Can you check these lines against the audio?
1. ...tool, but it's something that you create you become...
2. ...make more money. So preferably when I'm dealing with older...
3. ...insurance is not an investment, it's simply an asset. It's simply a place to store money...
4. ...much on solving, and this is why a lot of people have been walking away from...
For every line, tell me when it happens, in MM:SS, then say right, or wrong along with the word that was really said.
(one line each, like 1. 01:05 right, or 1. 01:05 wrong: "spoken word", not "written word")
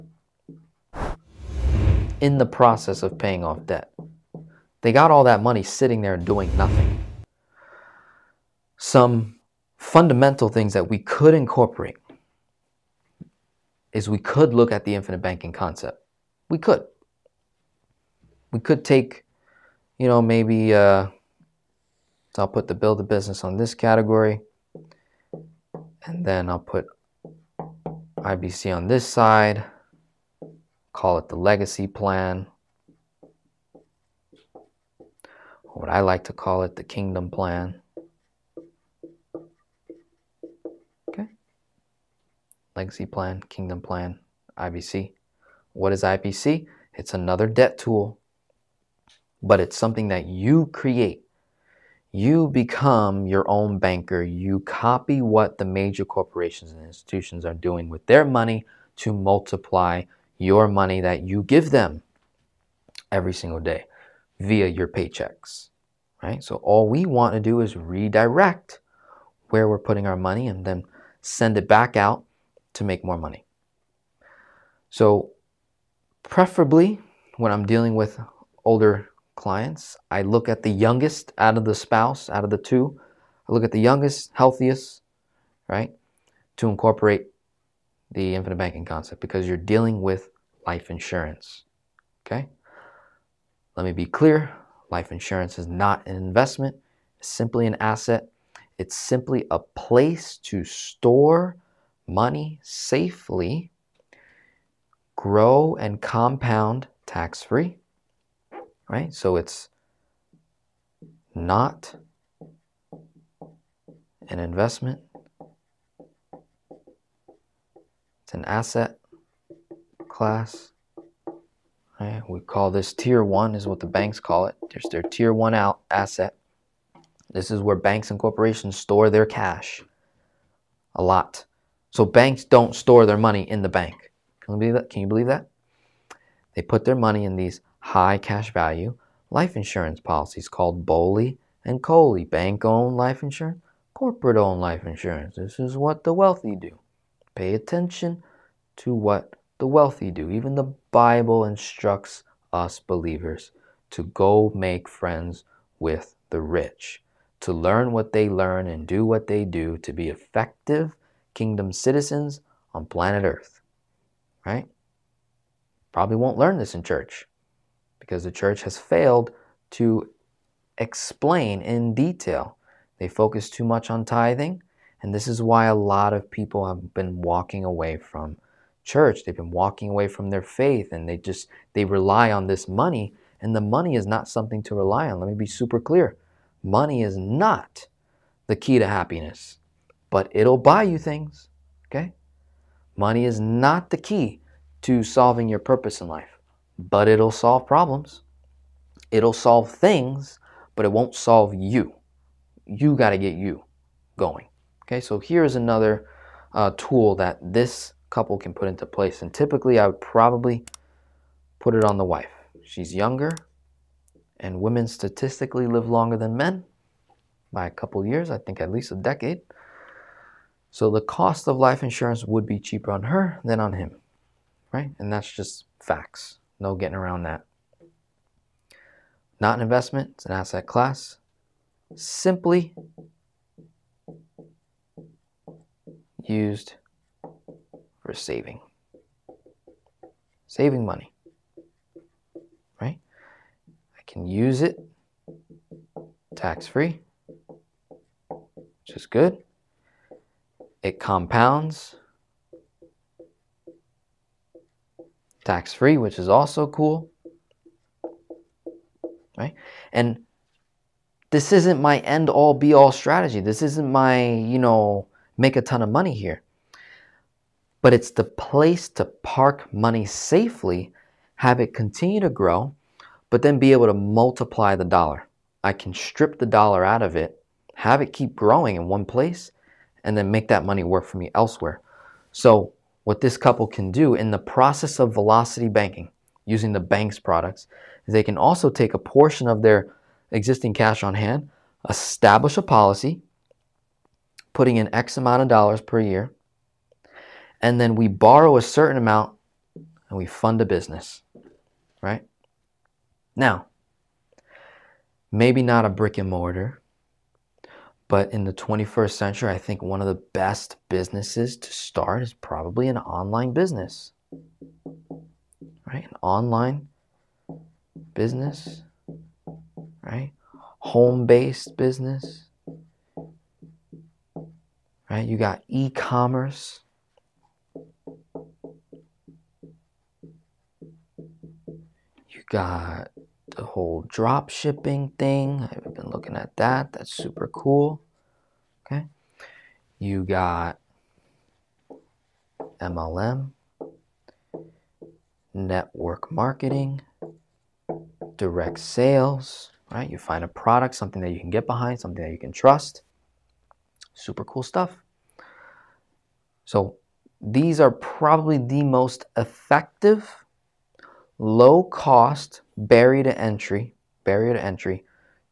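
1. 00:47 right
2. 01:12 right
3. 01:35 right
4. 02:53 wrong: "tithing", not "solving".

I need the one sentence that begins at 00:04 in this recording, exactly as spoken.
They got all that money sitting there doing nothing.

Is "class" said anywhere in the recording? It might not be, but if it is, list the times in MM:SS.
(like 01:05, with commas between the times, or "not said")
02:00, 03:50.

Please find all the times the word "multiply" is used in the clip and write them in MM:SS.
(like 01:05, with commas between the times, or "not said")
00:59, 04:33.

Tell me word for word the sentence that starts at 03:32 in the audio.
She's younger, and women statistically live longer than men by a couple years, I think at least a decade.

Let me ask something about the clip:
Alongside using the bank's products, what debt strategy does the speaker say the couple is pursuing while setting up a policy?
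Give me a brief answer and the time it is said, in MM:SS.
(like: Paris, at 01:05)
velocity banking, at 04:45.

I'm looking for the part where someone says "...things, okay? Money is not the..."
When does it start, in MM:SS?
03:10.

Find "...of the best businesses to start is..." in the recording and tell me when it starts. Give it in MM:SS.
05:09.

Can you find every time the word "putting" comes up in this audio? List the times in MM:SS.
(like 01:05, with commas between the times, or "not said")
01:09, 04:54.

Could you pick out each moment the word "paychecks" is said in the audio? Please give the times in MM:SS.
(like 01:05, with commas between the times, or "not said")
01:04.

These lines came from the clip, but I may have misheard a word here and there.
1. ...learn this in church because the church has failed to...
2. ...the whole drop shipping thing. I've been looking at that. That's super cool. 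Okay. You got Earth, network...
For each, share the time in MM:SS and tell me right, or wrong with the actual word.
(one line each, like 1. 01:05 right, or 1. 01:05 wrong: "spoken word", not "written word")
1. 02:46 right
2. 05:33 wrong: "MLM", not "Earth".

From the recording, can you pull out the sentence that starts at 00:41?
Okay, legacy plan, kingdom plan, IBC.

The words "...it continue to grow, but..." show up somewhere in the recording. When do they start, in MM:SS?
04:31.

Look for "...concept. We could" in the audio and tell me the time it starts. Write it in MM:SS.
00:15.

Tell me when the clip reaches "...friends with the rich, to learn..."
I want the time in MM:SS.
02:34.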